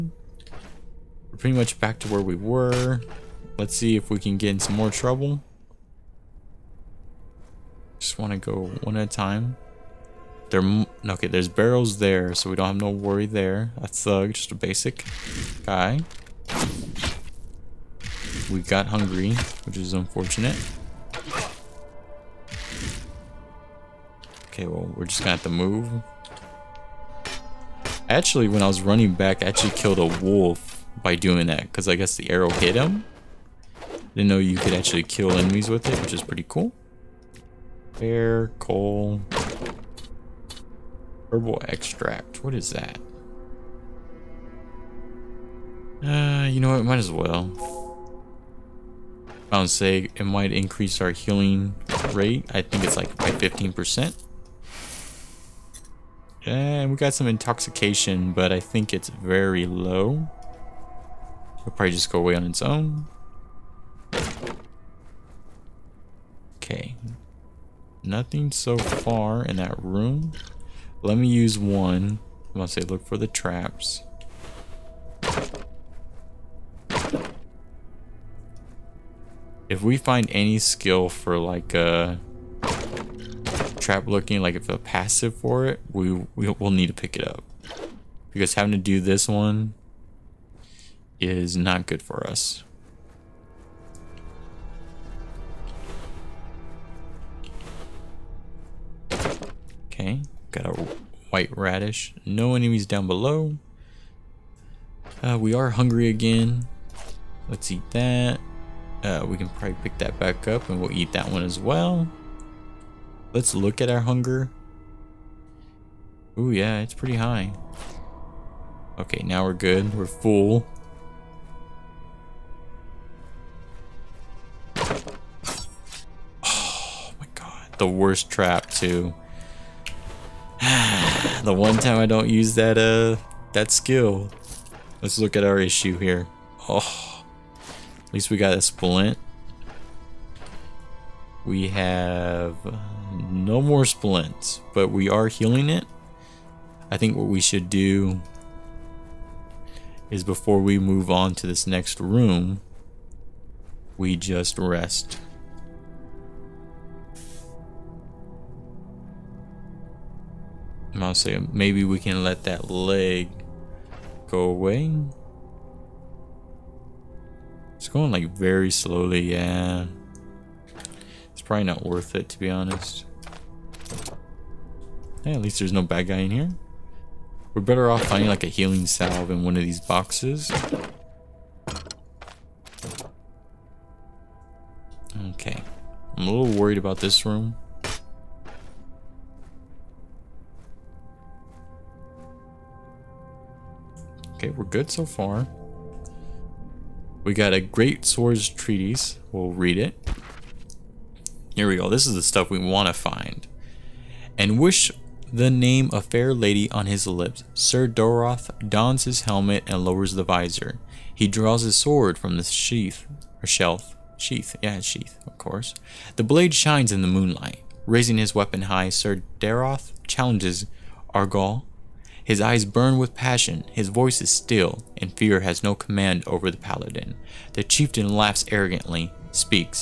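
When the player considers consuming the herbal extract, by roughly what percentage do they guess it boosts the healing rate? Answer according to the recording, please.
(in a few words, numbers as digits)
15%.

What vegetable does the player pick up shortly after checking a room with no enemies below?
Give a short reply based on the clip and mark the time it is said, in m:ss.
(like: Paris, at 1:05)
white radish, at 1:41.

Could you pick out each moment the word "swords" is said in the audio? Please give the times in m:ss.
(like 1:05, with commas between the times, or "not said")
3:18, 3:31.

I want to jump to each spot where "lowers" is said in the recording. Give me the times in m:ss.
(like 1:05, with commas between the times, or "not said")
3:29.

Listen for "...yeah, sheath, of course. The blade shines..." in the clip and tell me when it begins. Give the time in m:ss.
3:34.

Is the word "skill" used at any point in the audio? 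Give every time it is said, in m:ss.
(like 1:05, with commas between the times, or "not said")
1:20, 2:13.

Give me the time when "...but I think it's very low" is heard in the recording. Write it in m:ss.
0:58.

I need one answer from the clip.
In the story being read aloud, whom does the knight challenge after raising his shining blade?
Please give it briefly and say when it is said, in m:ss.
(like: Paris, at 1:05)
Argal, at 3:41.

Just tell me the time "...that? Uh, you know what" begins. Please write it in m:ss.
0:42.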